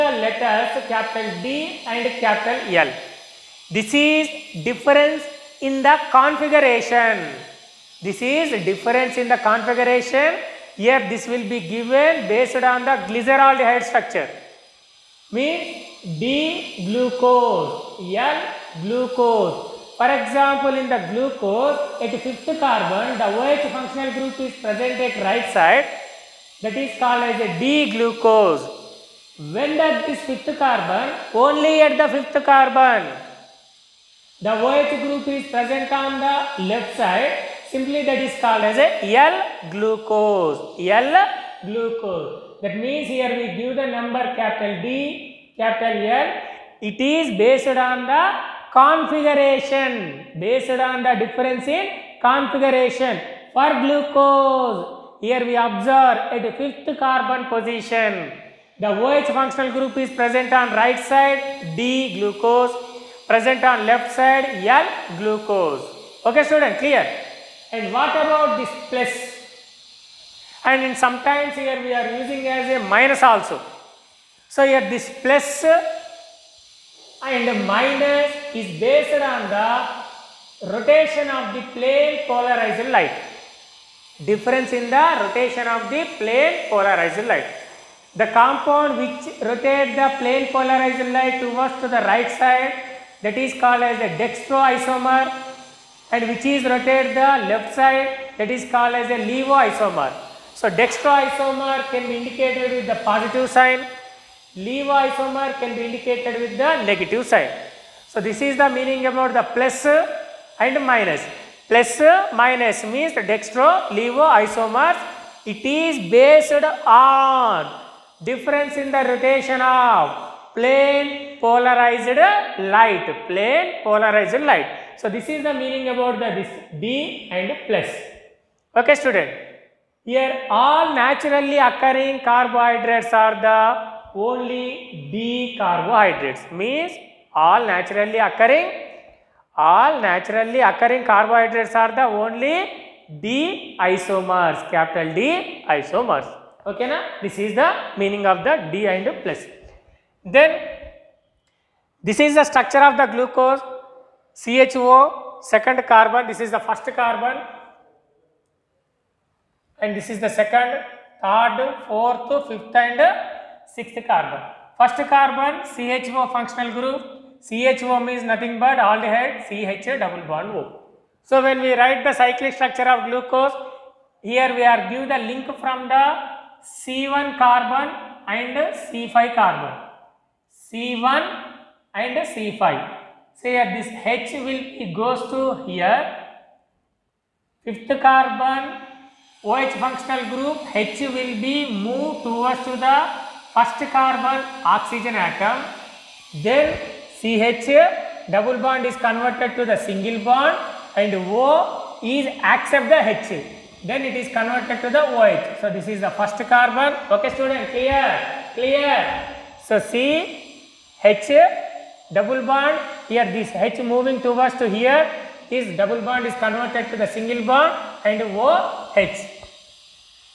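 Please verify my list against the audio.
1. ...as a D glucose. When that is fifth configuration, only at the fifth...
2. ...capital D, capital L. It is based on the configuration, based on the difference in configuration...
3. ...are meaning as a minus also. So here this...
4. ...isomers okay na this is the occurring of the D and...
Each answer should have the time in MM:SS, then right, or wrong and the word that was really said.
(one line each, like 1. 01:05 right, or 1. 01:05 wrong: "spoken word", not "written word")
1. 00:27 wrong: "carbon", not "configuration"
2. 00:44 right
3. 01:11 wrong: "using", not "meaning"
4. 02:25 wrong: "meaning", not "occurring".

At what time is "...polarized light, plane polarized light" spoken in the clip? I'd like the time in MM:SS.
02:01.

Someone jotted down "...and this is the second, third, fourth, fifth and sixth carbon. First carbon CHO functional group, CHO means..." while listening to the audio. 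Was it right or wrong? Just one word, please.
right.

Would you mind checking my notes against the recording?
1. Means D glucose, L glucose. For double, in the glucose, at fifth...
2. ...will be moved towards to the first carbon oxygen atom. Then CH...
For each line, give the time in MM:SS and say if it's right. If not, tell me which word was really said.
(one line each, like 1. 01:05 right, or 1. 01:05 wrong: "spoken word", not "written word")
1. 00:15 wrong: "example", not "double"
2. 03:11 right.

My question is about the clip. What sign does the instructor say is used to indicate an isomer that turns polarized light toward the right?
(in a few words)
Positive sign.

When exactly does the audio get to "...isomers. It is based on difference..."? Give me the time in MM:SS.
01:53.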